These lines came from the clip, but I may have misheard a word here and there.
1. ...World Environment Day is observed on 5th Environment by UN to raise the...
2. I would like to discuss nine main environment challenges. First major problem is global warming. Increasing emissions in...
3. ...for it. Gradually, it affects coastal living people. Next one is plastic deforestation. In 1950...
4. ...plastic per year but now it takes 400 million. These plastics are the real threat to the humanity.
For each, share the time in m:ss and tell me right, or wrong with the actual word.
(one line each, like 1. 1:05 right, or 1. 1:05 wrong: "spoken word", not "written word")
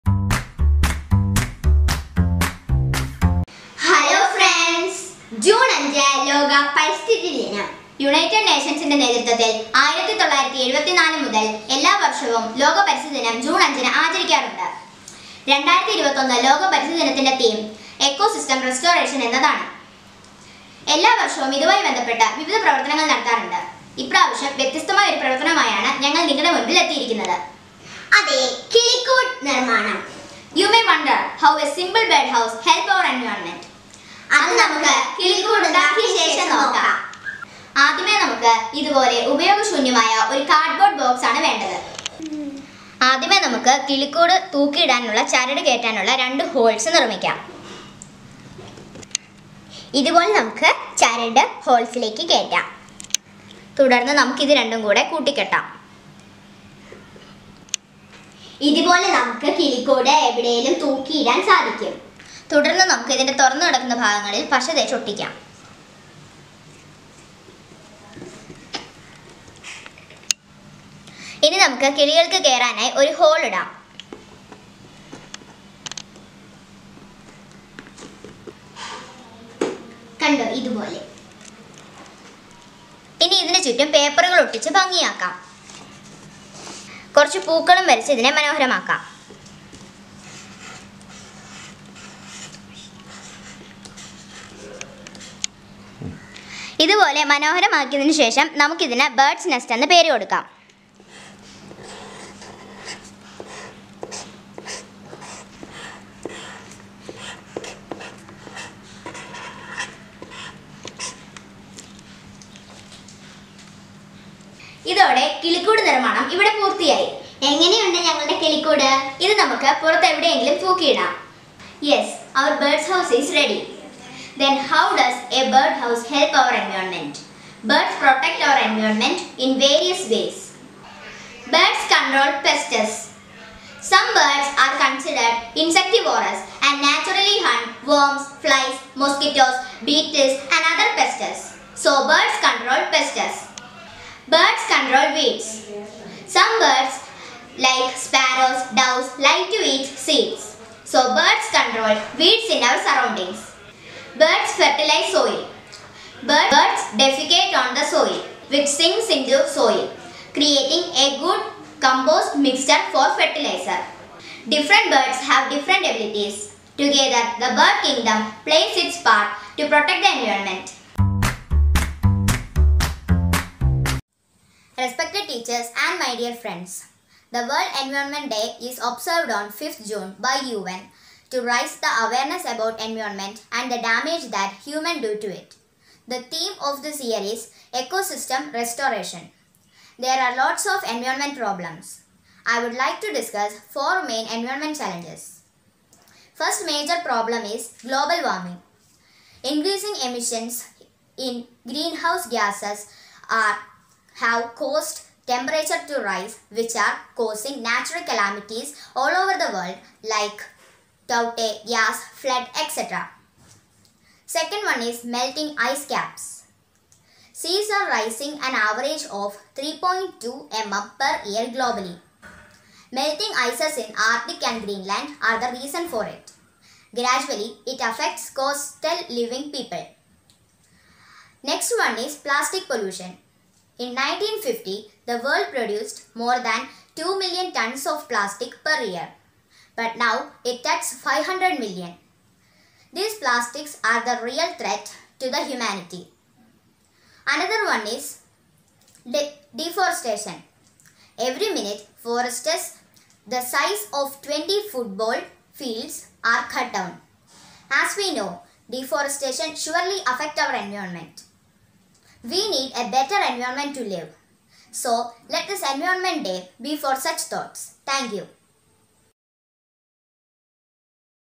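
1. 2:57 wrong: "June", not "Environment"
2. 3:12 wrong: "four", not "nine"
3. 3:45 wrong: "pollution", not "deforestation"
4. 3:58 wrong: "500", not "400".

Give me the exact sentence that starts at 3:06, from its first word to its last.
The theme of this year is Ecosystem Restoration.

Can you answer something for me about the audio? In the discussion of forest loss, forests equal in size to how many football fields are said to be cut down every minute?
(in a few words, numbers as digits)
20.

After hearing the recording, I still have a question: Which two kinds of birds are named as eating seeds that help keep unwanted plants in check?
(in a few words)
sparrows, doves.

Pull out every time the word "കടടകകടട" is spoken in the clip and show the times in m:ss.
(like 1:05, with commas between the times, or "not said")
0:55.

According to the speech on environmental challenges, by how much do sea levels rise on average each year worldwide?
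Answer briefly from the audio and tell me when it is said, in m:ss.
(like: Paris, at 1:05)
3.2 mm, at 3:39.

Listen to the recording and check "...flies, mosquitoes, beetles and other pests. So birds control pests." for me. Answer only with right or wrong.
right.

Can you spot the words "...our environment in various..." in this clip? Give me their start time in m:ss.
2:08.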